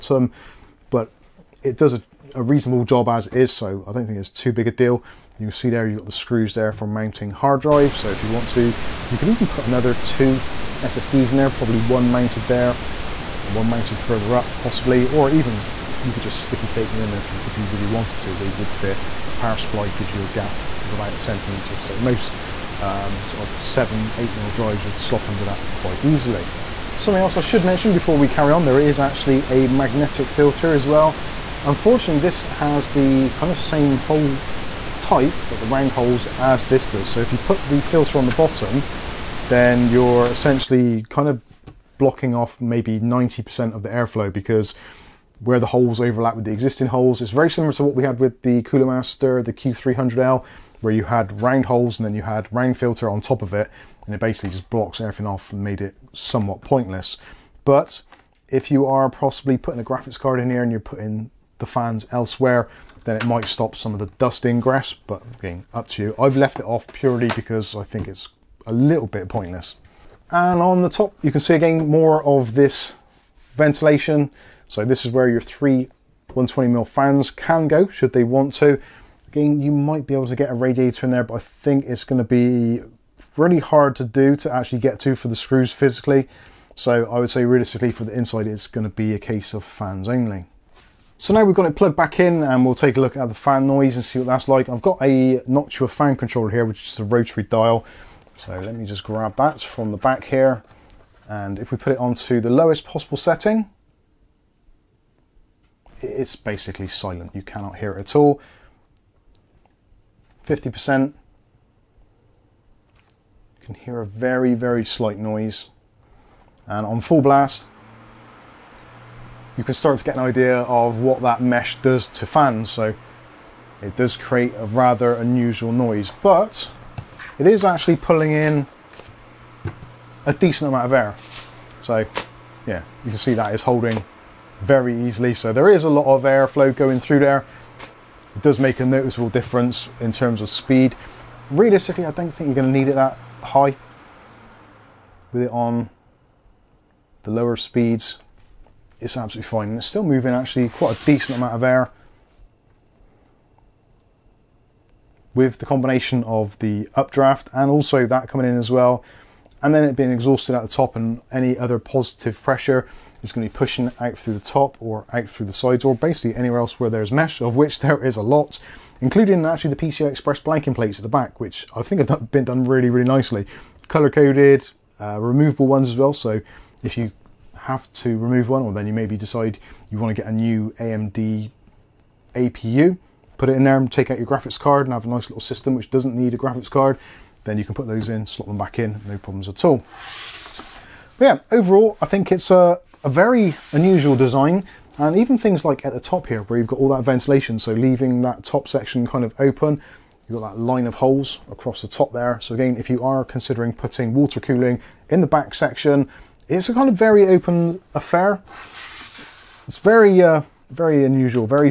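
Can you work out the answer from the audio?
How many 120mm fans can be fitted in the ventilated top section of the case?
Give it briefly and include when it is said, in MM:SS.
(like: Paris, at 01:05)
3, at 01:15.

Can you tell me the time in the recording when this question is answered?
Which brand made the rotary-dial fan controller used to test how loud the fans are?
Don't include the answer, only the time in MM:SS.
01:35.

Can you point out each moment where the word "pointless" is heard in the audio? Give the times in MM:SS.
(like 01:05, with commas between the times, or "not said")
00:56, 01:09.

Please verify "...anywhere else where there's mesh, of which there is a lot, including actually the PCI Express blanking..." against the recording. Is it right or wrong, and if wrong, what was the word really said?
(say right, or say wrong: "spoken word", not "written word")
right.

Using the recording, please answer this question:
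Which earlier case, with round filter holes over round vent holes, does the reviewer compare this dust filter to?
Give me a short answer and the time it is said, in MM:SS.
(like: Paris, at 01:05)
Cooler Master Q300L, at 00:49.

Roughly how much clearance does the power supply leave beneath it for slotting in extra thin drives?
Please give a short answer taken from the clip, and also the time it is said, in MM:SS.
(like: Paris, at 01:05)
1 centimeter, at 00:20.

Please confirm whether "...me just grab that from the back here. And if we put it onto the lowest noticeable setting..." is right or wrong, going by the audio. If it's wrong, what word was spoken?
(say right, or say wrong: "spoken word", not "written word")
wrong: "possible", not "noticeable".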